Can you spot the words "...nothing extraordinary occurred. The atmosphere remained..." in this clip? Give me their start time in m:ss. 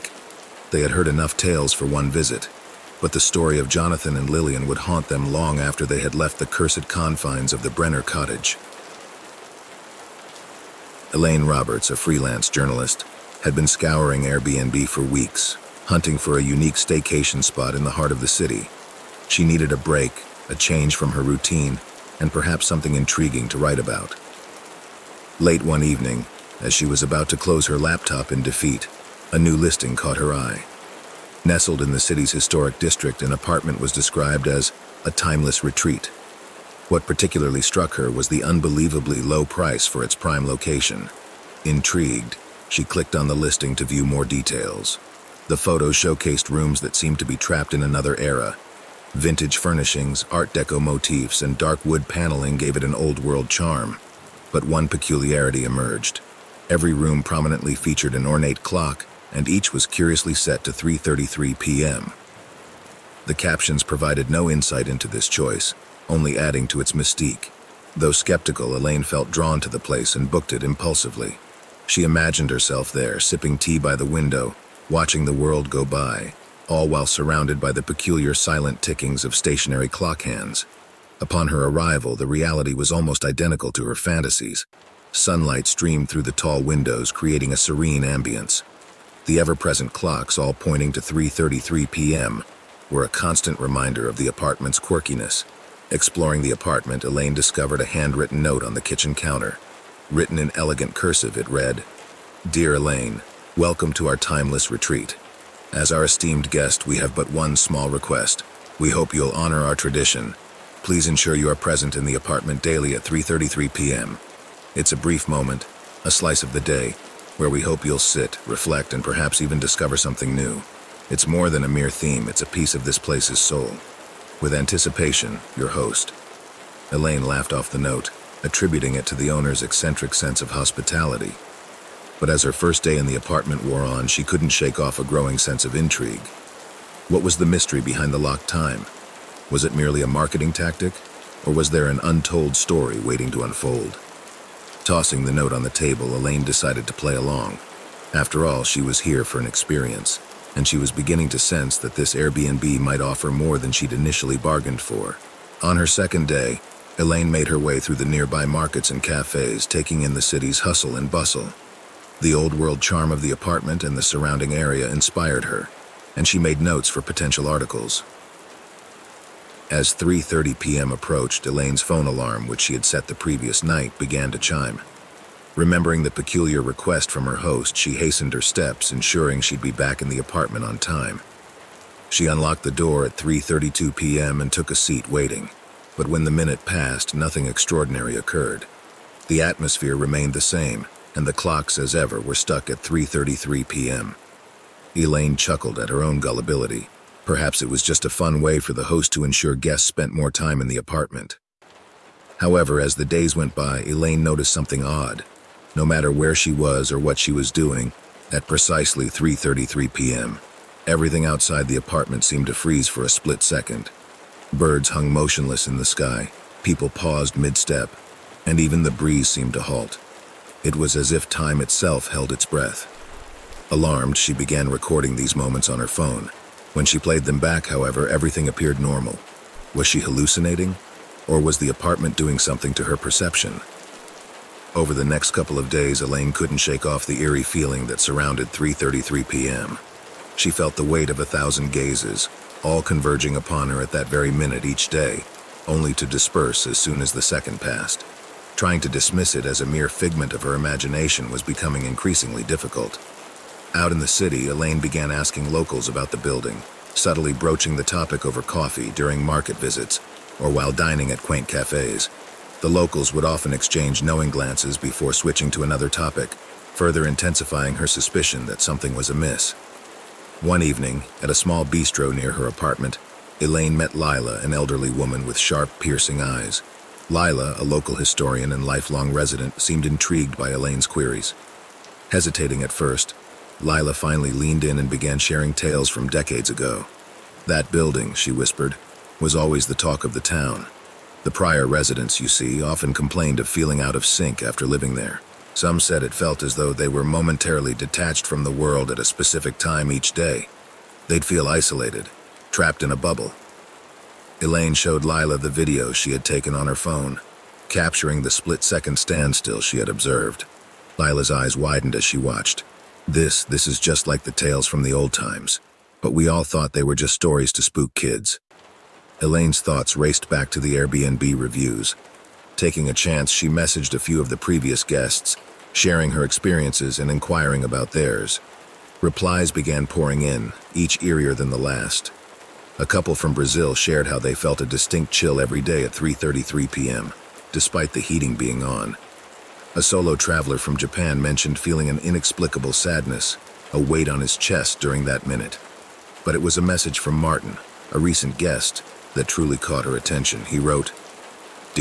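3:07.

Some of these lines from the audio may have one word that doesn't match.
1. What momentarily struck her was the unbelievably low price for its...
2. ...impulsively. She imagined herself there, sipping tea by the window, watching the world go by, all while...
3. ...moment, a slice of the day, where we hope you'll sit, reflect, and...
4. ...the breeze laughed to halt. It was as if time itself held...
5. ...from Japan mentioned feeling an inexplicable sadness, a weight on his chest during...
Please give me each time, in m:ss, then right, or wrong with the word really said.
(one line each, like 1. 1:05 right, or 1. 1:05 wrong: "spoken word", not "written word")
1. 0:36 wrong: "particularly", not "momentarily"
2. 1:10 right
3. 1:55 right
4. 3:38 wrong: "seemed", not "laughed"
5. 5:40 right.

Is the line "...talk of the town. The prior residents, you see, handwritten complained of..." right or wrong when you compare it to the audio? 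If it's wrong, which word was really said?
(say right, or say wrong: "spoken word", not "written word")
wrong: "often", not "handwritten".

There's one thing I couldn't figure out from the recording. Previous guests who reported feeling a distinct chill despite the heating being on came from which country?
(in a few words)
Brazil.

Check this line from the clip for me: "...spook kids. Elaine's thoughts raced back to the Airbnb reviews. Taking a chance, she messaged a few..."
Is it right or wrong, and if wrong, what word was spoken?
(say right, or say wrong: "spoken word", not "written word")
right.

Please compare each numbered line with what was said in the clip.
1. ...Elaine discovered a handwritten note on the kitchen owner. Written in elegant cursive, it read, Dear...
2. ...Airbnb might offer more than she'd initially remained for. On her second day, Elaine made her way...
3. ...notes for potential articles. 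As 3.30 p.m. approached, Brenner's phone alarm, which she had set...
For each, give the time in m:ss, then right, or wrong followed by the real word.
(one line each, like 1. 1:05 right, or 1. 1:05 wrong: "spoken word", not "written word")
1. 1:37 wrong: "counter", not "owner"
2. 2:32 wrong: "bargained", not "remained"
3. 2:46 wrong: "Elaine", not "Brenner".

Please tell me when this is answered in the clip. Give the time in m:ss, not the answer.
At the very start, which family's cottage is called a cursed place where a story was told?
0:07.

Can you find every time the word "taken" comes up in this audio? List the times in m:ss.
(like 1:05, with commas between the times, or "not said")
5:06.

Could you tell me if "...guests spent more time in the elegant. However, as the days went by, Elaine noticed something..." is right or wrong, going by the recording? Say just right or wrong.
wrong.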